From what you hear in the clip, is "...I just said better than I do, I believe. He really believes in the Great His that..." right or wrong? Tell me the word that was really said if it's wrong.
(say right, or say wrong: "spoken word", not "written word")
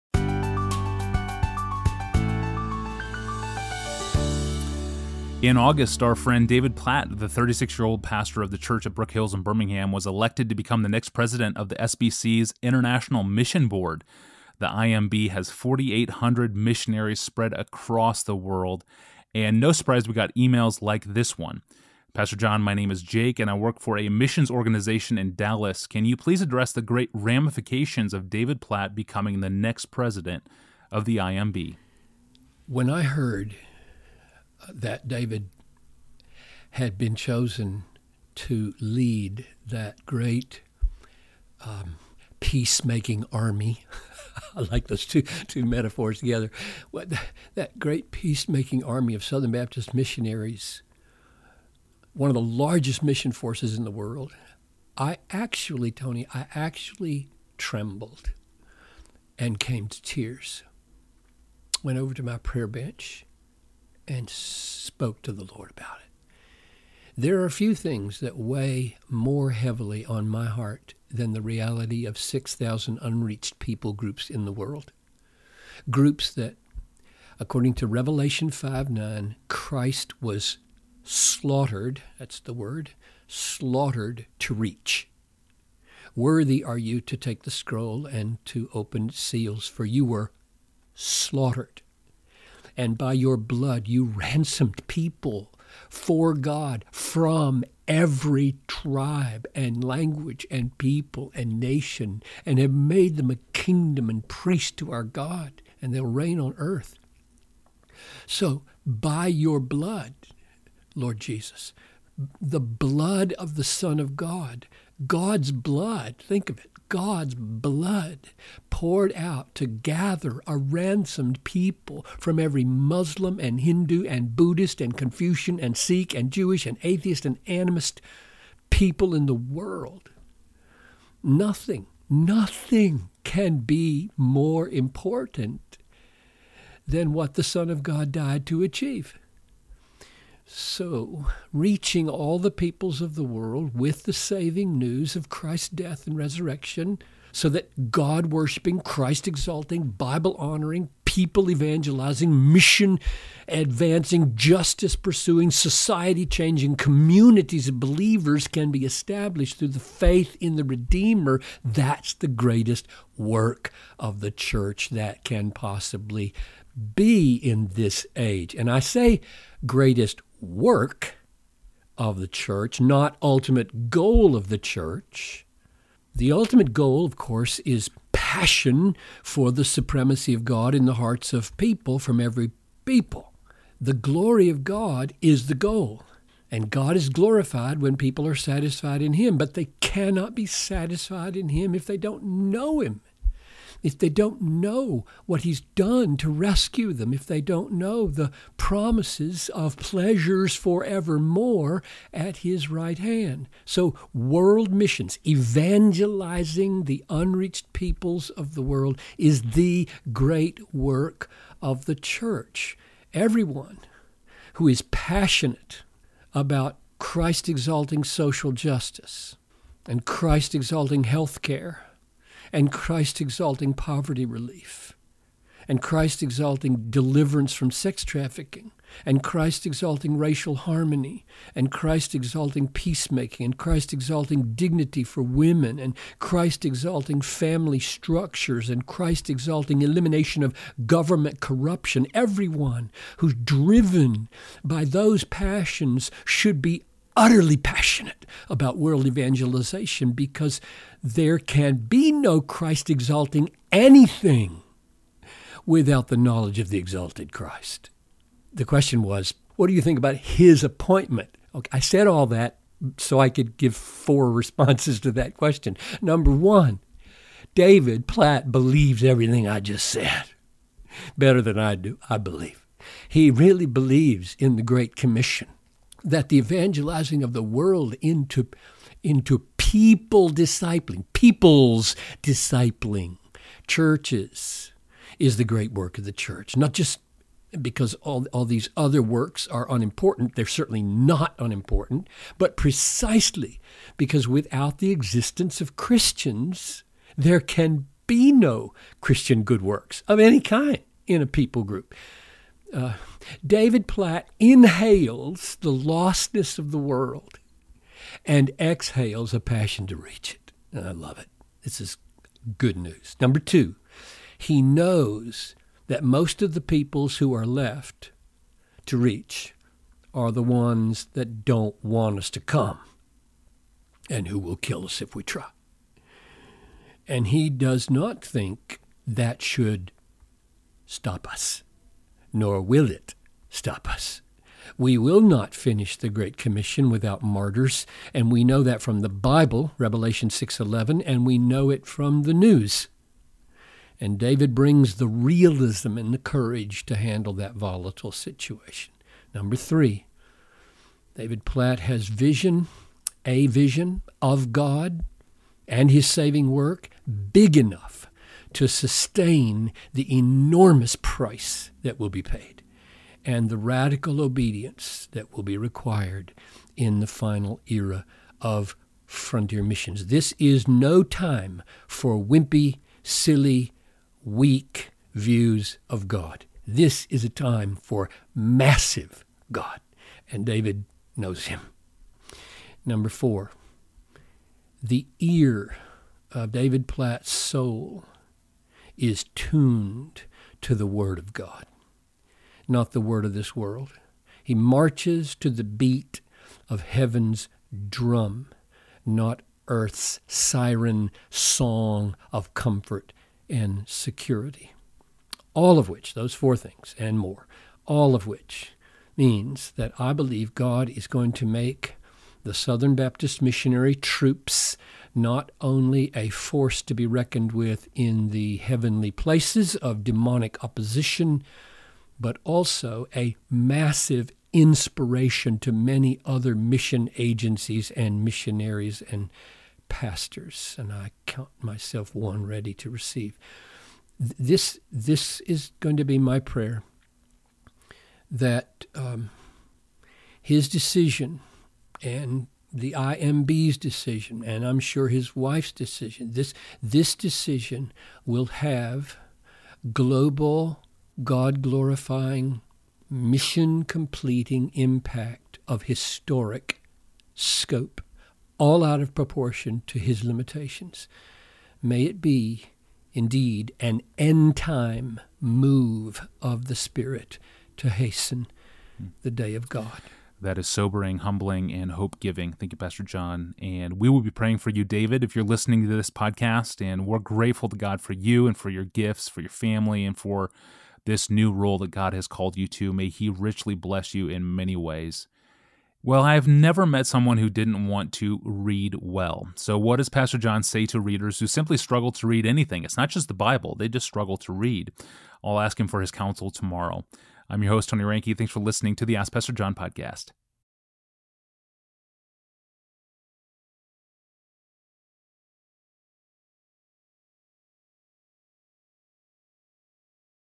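wrong: "Commission", not "His".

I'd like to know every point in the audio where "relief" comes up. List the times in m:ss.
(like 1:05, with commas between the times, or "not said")
3:44.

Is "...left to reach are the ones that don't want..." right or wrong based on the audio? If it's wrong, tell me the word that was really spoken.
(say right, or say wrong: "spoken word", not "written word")
right.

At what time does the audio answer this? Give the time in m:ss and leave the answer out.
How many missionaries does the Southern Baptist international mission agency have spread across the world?
0:15.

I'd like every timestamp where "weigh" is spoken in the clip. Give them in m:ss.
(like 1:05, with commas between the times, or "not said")
1:08.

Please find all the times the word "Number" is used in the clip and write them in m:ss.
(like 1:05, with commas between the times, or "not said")
4:26, 5:13, 5:49, 6:22.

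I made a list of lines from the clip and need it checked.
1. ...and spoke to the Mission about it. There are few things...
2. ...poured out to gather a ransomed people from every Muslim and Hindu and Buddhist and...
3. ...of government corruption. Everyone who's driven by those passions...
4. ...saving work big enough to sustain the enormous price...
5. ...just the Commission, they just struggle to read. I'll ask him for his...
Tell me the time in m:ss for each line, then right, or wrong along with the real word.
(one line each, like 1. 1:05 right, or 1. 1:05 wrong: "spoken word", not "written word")
1. 1:04 wrong: "Lord", not "Mission"
2. 1:58 right
3. 4:00 right
4. 5:56 right
5. 8:13 wrong: "Bible", not "Commission".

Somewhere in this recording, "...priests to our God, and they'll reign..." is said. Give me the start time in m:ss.
1:44.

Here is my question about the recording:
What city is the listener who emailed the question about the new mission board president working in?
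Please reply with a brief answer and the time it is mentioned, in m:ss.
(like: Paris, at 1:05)
Dallas, at 0:25.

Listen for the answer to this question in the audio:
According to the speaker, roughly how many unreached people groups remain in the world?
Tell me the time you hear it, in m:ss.
1:12.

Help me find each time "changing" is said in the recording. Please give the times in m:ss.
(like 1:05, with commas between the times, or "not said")
2:36.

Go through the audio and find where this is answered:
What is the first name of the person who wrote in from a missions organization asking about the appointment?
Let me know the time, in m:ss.
0:23.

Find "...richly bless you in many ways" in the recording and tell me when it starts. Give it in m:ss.
8:03.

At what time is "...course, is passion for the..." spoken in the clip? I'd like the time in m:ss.
2:57.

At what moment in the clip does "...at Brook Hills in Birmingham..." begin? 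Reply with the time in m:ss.
0:08.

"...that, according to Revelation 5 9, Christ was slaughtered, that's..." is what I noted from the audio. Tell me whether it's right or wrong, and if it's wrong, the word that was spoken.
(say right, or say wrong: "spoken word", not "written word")
right.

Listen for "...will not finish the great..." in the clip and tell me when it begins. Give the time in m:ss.
5:34.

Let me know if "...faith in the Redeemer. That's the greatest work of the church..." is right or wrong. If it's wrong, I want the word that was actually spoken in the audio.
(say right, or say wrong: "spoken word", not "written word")
right.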